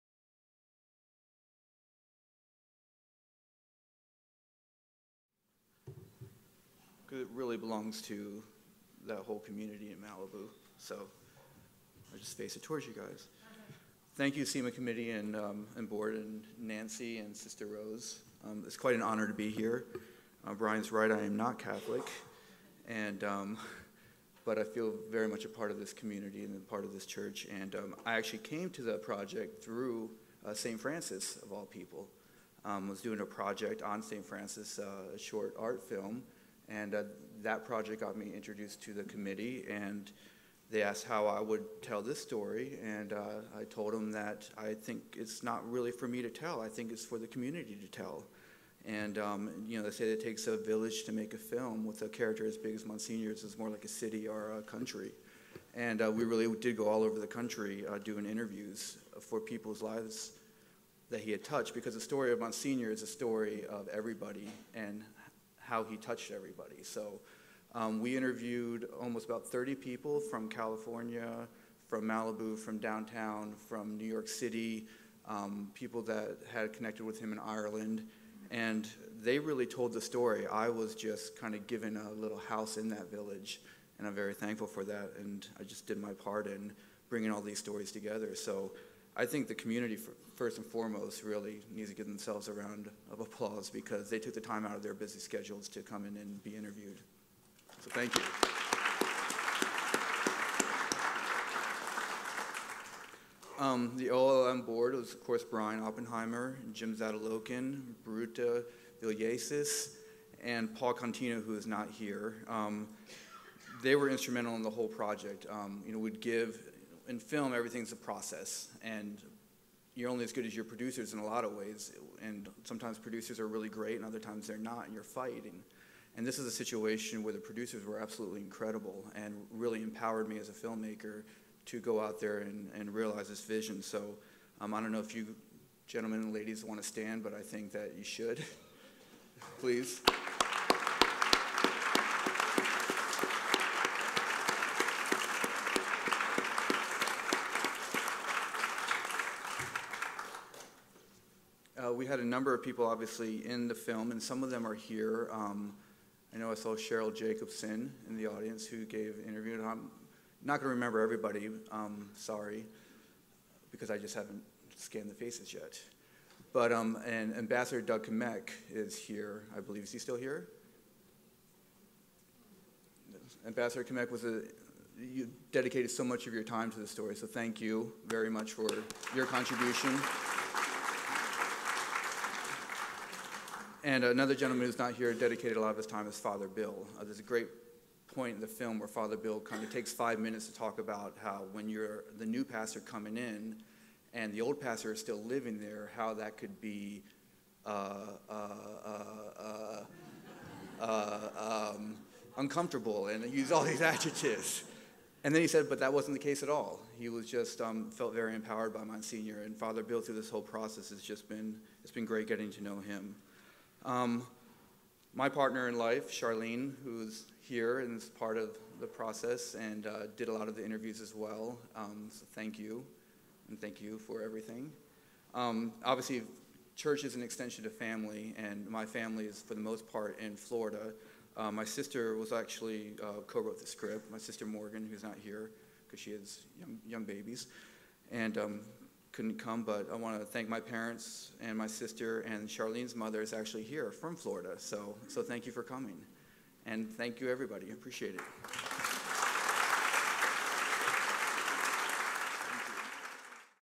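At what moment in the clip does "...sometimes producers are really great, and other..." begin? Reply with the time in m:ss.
2:02.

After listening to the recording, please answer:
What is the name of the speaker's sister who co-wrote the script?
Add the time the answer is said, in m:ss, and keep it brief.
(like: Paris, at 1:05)
Morgan, at 3:54.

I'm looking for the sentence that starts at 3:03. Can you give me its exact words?
and another gentleman who's not here dedicated a lot of his time is Father Bill.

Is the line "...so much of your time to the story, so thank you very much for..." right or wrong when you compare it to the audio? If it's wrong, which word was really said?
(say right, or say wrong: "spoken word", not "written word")
right.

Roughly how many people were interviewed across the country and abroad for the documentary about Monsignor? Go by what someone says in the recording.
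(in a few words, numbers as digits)
30.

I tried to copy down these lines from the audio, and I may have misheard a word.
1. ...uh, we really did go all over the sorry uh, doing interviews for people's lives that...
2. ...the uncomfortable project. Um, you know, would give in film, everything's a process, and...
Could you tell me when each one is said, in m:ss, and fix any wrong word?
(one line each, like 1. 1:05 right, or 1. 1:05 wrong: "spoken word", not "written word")
1. 0:56 wrong: "country", not "sorry"
2. 1:54 wrong: "whole", not "uncomfortable".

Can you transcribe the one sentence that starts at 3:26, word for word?
He was just um, felt very empowered by Monsignor and Father Bill through this whole process.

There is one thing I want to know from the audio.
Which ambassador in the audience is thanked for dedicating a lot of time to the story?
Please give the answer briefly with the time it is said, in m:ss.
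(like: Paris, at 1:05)
Doug Kmiec, at 2:47.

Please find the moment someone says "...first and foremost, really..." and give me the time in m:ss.
1:30.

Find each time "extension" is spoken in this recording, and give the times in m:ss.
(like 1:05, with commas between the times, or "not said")
3:47.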